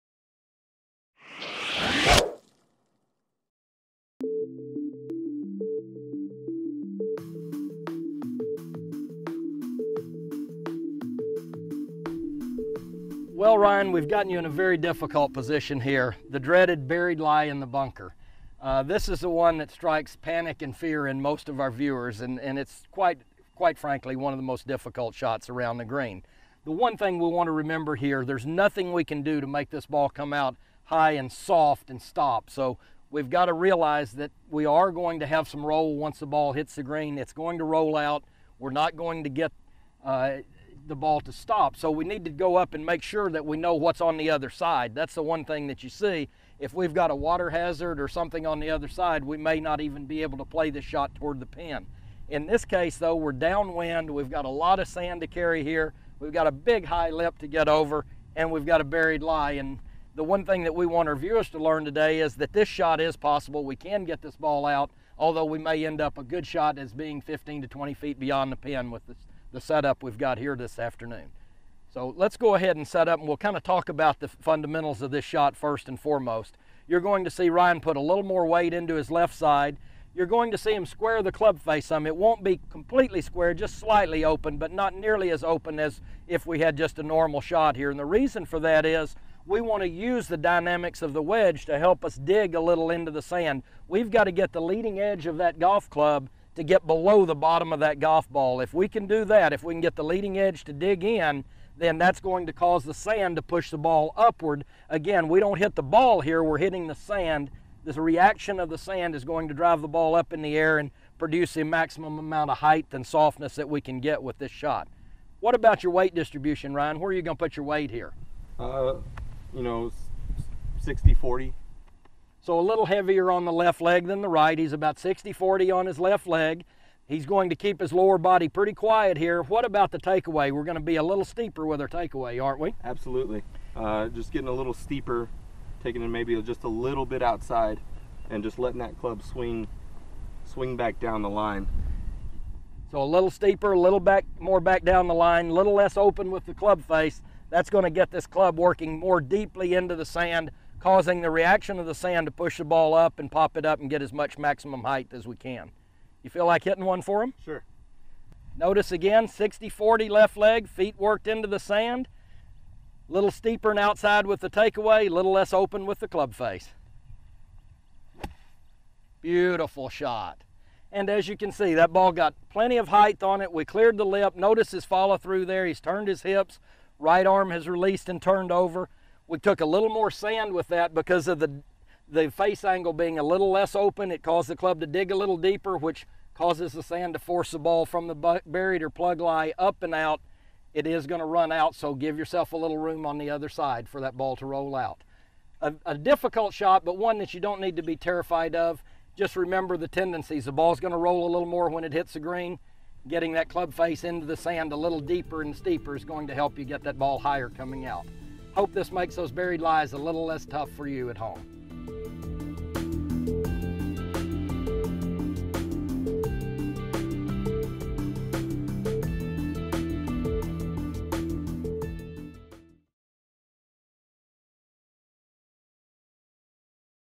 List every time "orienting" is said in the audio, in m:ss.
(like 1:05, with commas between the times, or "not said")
not said.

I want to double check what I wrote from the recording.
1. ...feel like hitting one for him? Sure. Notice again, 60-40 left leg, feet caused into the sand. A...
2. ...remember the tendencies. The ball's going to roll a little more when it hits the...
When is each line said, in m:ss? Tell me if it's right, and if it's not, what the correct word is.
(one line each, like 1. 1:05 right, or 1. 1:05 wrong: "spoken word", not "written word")
1. 2:36 wrong: "worked", not "caused"
2. 3:19 right.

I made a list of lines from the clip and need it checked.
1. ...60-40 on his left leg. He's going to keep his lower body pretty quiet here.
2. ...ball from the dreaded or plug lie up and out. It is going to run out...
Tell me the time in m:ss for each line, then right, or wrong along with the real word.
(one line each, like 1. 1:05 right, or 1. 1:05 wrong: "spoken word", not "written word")
1. 2:04 right
2. 3:07 wrong: "buried", not "dreaded".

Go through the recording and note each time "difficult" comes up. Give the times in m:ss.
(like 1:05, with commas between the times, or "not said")
0:14, 0:24, 3:15.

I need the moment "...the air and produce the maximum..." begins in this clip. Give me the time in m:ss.
1:50.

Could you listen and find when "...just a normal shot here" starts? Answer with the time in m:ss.
1:26.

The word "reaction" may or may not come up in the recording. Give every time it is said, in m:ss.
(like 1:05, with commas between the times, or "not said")
1:47, 2:31.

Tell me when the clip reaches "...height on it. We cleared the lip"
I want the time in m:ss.
2:52.